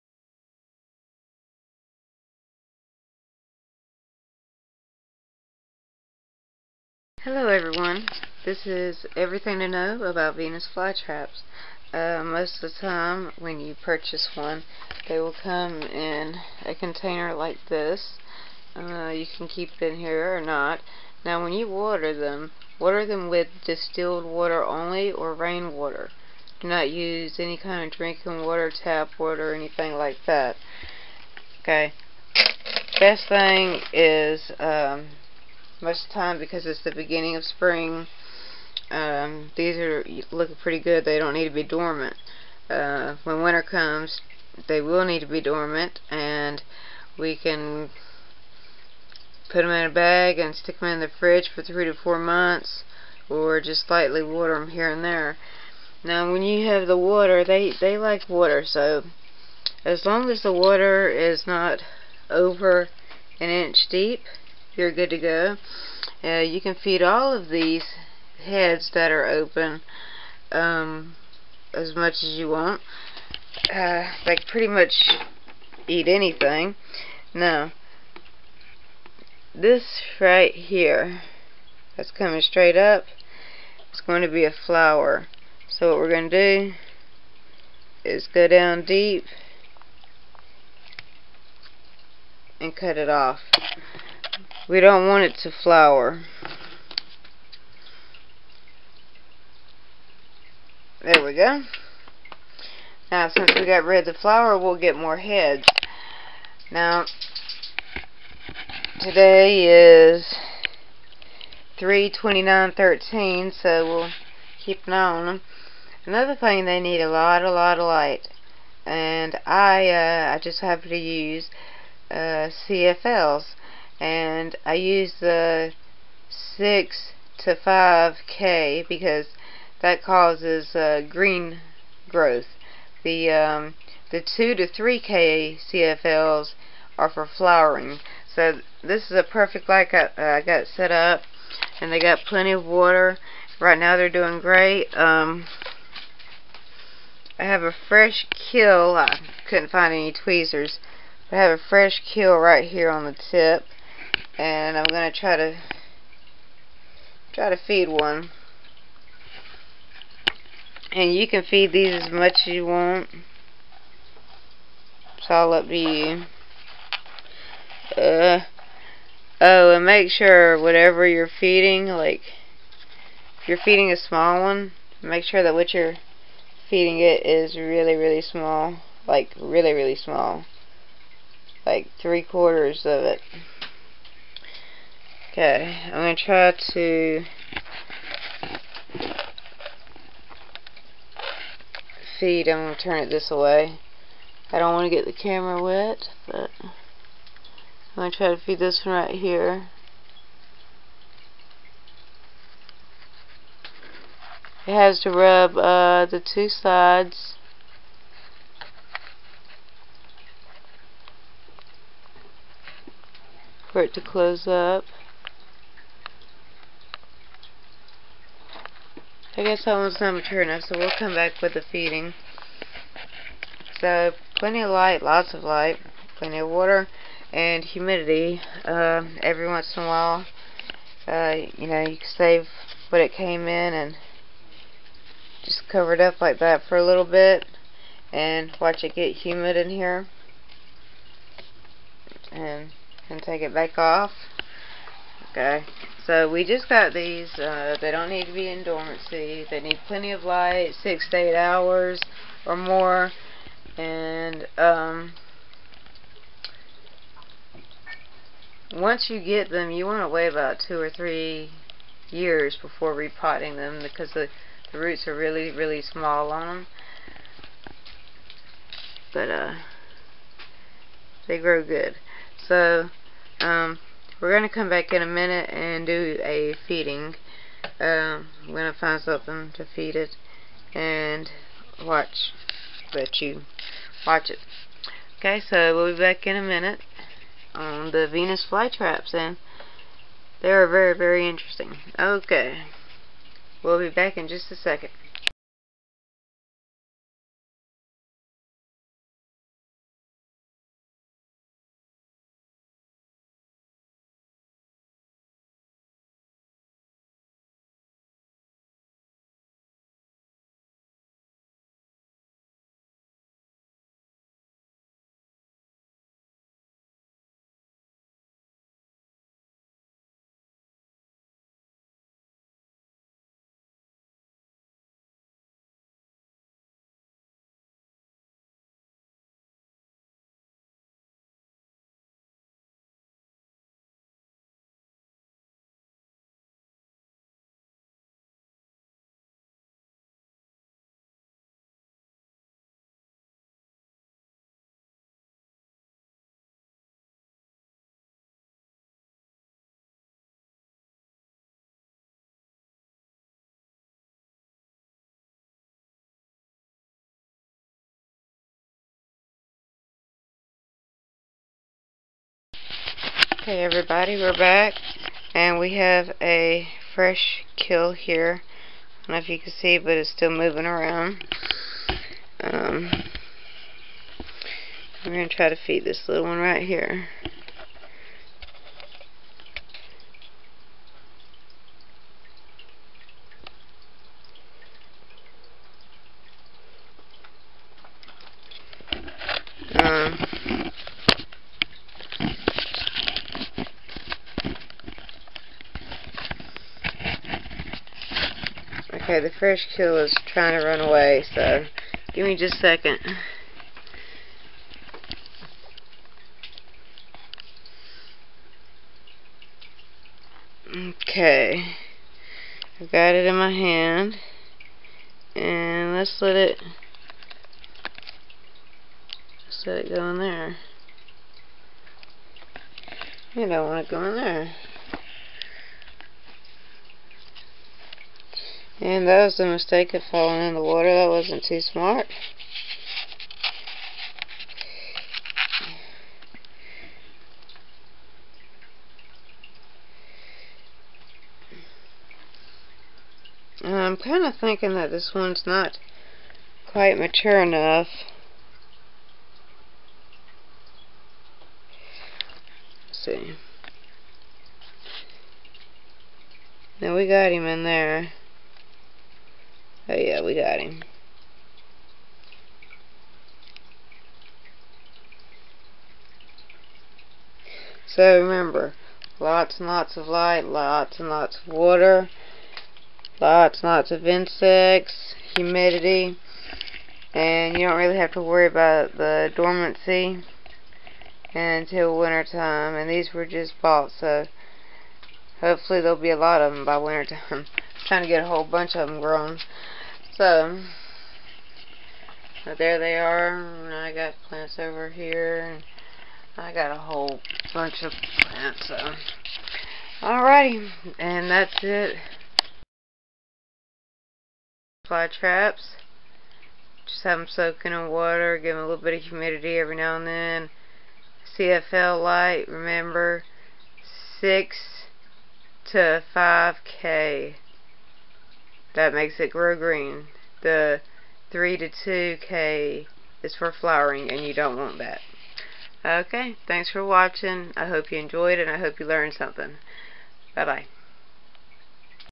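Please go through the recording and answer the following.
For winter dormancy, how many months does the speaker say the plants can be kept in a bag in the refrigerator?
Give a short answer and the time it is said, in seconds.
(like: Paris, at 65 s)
3 to 4 months, at 51 s.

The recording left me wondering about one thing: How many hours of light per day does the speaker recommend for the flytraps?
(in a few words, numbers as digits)
6 to 8 hours.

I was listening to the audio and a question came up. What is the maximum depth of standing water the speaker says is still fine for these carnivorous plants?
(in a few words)
an inch.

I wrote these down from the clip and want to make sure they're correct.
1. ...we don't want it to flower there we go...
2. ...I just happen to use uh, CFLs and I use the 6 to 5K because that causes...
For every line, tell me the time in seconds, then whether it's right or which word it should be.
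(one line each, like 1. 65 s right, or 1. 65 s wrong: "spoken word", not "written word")
1. 94 s right
2. 120 s right.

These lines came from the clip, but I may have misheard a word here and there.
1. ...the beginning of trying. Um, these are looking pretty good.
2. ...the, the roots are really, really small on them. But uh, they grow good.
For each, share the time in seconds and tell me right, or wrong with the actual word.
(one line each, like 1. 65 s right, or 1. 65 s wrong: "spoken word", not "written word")
1. 36 s wrong: "spring", not "trying"
2. 264 s right.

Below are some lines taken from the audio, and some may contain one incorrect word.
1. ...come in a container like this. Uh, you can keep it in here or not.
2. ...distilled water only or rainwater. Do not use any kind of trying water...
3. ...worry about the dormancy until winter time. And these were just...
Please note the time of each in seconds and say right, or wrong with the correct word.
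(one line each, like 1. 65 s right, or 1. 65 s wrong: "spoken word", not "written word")
1. 15 s right
2. 23 s wrong: "drinking", not "trying"
3. 478 s right.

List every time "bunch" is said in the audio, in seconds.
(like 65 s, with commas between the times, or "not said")
488 s, 497 s.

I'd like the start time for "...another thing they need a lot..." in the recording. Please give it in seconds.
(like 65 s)
116 s.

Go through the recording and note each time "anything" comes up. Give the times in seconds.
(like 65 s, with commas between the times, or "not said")
29 s, 76 s.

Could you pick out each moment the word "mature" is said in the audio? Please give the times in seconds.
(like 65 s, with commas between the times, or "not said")
220 s, 446 s.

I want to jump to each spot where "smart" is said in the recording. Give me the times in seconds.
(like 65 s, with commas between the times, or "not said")
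431 s.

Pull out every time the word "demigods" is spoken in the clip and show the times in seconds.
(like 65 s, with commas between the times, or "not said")
not said.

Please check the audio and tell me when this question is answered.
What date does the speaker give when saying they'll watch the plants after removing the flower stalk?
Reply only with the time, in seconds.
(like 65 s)
111 s.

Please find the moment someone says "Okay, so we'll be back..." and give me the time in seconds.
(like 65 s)
285 s.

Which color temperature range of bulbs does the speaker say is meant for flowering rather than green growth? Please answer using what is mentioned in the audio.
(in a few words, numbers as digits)
2 to 3K.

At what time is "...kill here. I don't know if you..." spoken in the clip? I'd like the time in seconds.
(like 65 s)
367 s.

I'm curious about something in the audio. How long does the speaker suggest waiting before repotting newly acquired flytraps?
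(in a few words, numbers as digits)
2 or 3 years.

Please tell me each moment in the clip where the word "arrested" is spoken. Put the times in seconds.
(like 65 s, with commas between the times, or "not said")
not said.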